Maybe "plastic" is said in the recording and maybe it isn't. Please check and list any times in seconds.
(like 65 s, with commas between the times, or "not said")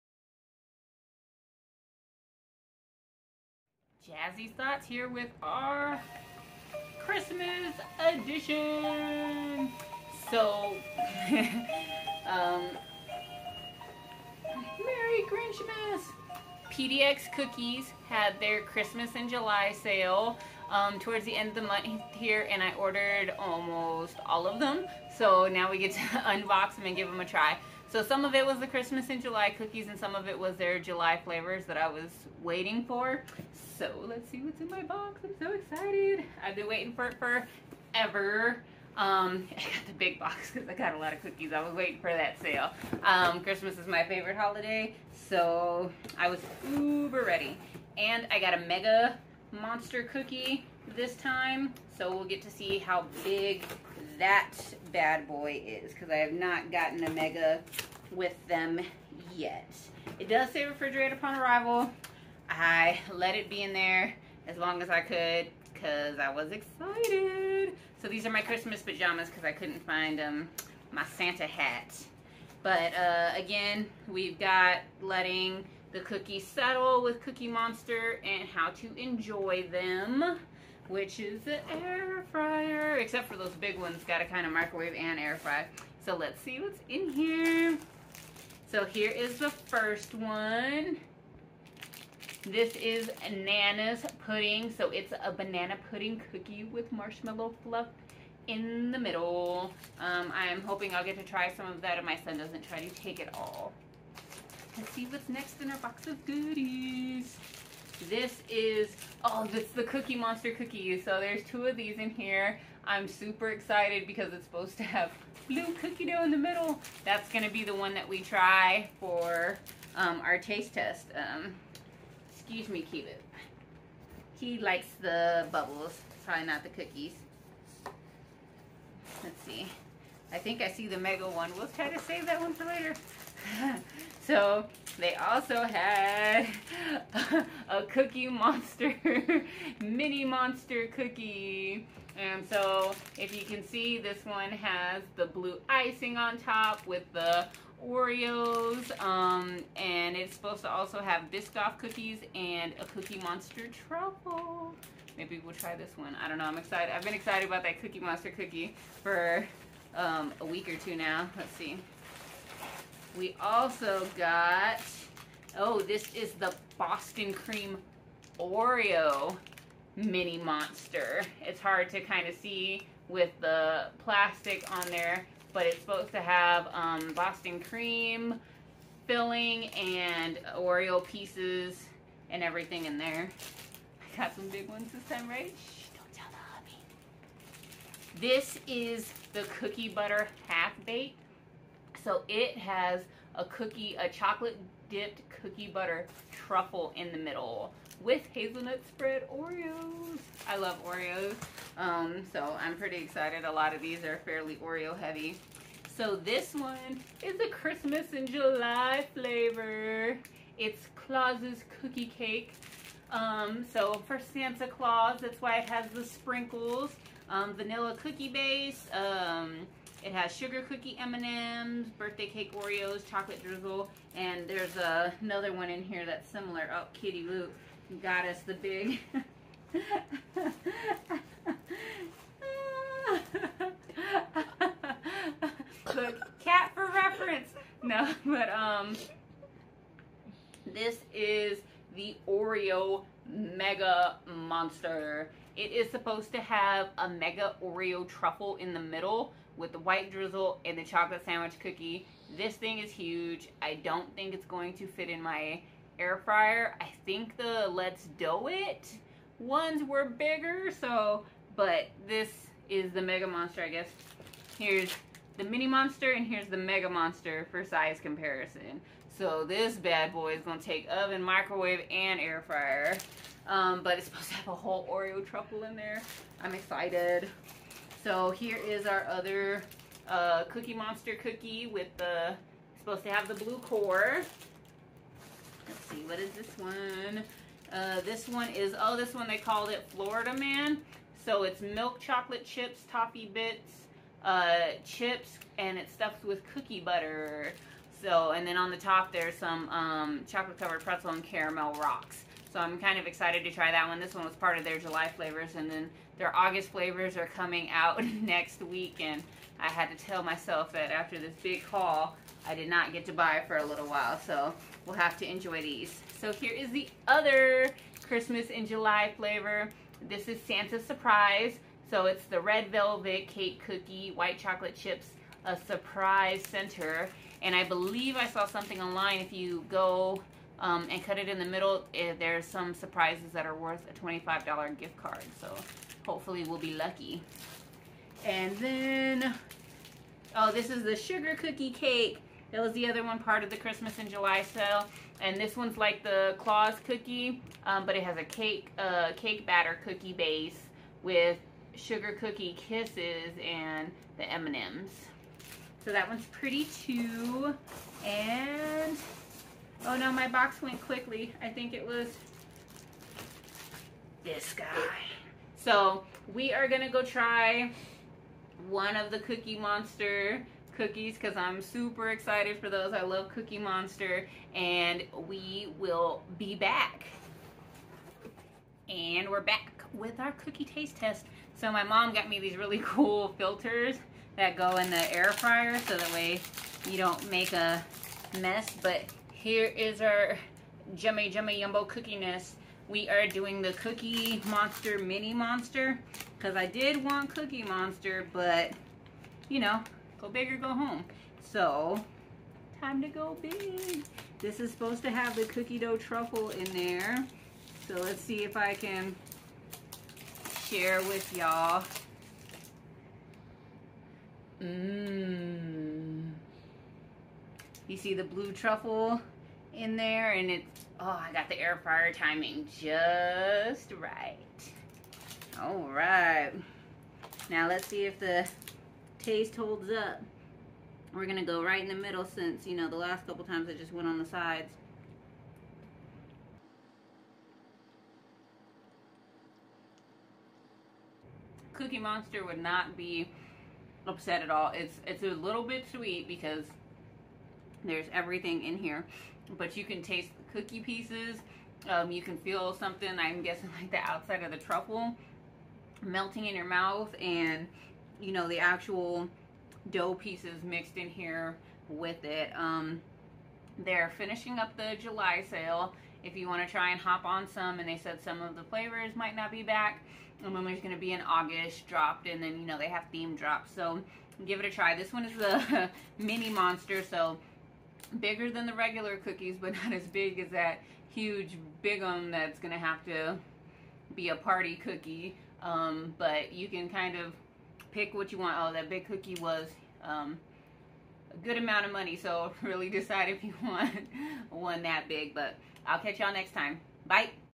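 174 s.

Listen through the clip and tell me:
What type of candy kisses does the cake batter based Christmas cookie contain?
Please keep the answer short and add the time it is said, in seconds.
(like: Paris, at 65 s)
sugar cookie kisses, at 351 s.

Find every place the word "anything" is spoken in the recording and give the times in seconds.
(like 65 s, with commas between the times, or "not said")
not said.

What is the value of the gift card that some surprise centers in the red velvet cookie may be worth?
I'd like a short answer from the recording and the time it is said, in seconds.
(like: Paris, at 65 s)
$25, at 333 s.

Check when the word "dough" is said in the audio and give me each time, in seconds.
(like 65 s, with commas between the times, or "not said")
116 s, 405 s, 459 s.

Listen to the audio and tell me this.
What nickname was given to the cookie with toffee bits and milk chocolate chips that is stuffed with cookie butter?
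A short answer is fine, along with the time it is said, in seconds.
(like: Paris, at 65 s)
Florida Man, at 289 s.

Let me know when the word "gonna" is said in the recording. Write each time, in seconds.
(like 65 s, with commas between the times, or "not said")
117 s, 270 s, 366 s, 431 s.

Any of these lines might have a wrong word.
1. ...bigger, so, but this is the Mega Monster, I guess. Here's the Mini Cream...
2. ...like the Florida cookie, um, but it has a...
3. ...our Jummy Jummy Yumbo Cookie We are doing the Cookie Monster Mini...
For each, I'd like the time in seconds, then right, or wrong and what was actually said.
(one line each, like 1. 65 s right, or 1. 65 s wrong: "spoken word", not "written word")
1. 260 s wrong: "Monster", not "Cream"
2. 345 s wrong: "Claus", not "Florida"
3. 390 s right.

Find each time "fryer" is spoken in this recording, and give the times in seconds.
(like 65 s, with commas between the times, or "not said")
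82 s, 256 s, 272 s, 385 s, 421 s.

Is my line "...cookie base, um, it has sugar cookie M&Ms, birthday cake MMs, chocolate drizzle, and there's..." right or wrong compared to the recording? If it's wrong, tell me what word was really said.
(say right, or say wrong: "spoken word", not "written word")
wrong: "Oreos", not "MMs".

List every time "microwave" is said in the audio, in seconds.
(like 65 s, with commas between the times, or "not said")
84 s, 271 s.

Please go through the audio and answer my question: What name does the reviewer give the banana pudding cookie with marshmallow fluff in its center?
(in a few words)
Nana's pudding.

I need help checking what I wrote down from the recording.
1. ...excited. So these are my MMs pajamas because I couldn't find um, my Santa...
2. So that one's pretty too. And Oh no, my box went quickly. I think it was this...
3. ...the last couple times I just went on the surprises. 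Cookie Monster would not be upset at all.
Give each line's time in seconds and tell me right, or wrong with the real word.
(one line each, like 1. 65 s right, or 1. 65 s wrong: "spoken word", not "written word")
1. 66 s wrong: "Christmas", not "MMs"
2. 355 s right
3. 432 s wrong: "sides", not "surprises".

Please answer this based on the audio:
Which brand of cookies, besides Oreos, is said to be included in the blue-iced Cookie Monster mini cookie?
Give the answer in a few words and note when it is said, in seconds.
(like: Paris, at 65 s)
Biscoff, at 151 s.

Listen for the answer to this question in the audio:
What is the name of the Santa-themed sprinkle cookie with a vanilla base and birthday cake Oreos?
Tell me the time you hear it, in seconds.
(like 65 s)
210 s.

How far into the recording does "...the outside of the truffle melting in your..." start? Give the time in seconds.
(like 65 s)
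453 s.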